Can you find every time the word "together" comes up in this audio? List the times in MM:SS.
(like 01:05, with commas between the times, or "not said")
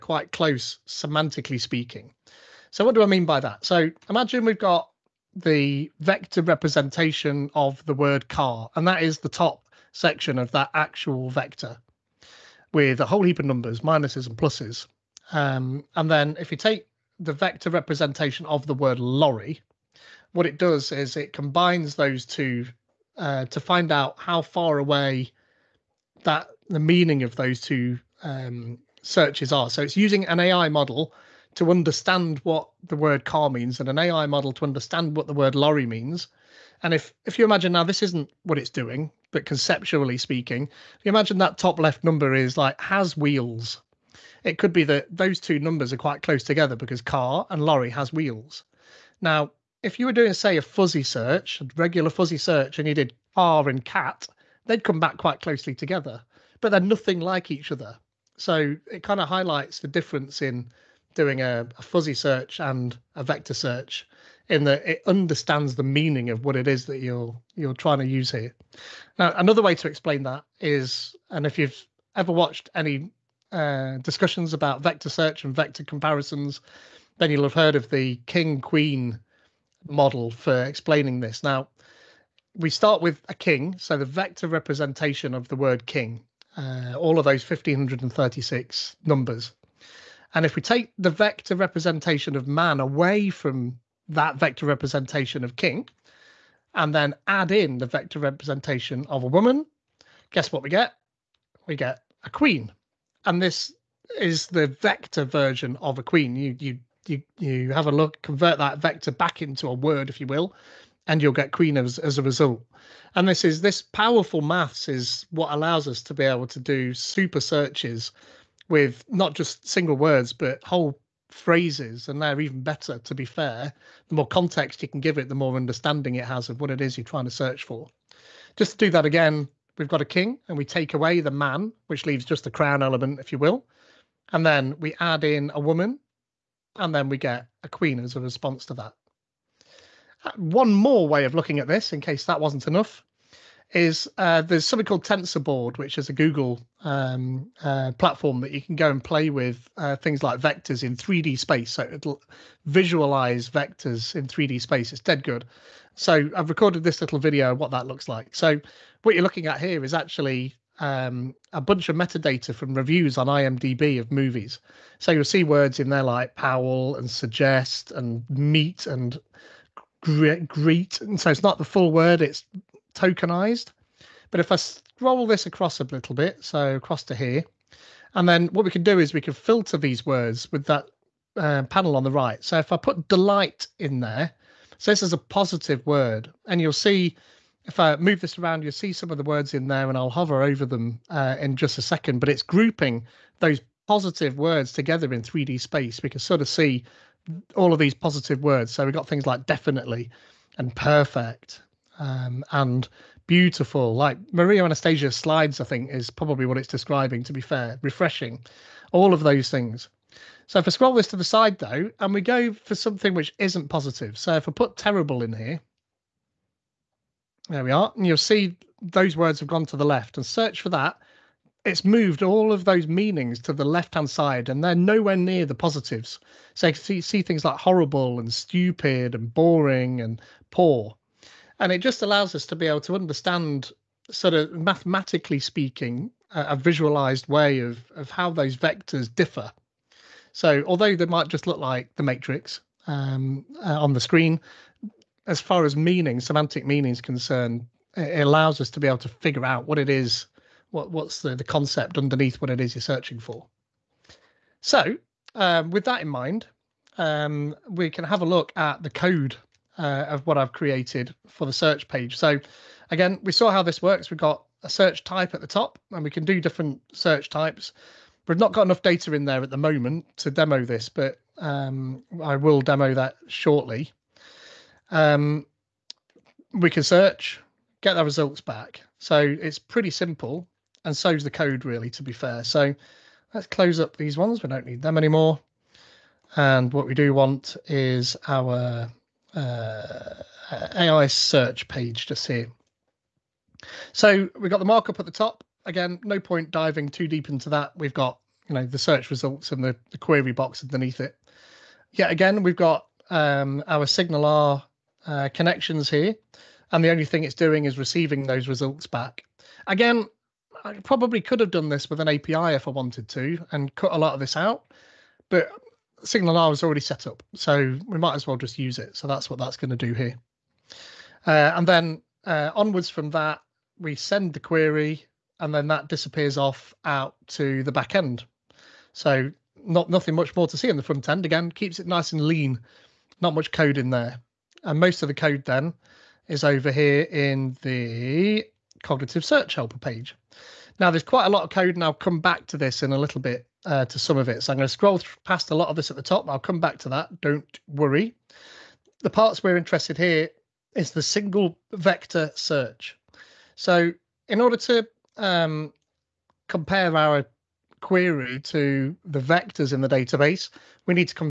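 00:46, 00:55, 03:14.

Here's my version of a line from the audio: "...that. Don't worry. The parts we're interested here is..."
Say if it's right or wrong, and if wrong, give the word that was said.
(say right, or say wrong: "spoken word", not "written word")
right.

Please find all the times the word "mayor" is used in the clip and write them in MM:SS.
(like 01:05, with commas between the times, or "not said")
not said.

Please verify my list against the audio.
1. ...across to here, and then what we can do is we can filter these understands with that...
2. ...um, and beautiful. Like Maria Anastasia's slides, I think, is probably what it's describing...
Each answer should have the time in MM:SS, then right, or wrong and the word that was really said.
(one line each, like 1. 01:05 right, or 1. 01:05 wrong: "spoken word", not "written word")
1. 02:56 wrong: "words", not "understands"
2. 03:21 right.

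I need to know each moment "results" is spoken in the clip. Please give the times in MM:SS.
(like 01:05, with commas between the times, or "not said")
01:52, 04:38, 04:59, 05:08.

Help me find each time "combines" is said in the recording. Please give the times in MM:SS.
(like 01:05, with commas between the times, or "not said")
00:21.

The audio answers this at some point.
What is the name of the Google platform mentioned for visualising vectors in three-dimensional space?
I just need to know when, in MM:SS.
02:25.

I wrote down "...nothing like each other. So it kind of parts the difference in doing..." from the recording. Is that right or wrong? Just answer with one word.
wrong.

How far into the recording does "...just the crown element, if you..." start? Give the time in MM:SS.
02:12.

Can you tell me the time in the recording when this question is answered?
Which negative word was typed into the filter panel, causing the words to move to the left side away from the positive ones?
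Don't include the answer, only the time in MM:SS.
03:34.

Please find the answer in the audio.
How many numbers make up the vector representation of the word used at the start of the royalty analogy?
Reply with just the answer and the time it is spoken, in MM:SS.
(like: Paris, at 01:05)
1536, at 01:27.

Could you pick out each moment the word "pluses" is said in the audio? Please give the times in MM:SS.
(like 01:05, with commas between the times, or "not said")
00:14.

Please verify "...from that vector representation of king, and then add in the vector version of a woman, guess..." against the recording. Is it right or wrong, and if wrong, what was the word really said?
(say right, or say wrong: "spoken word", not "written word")
wrong: "representation", not "version".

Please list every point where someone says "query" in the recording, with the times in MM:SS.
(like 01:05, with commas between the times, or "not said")
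04:59, 05:24, 05:57.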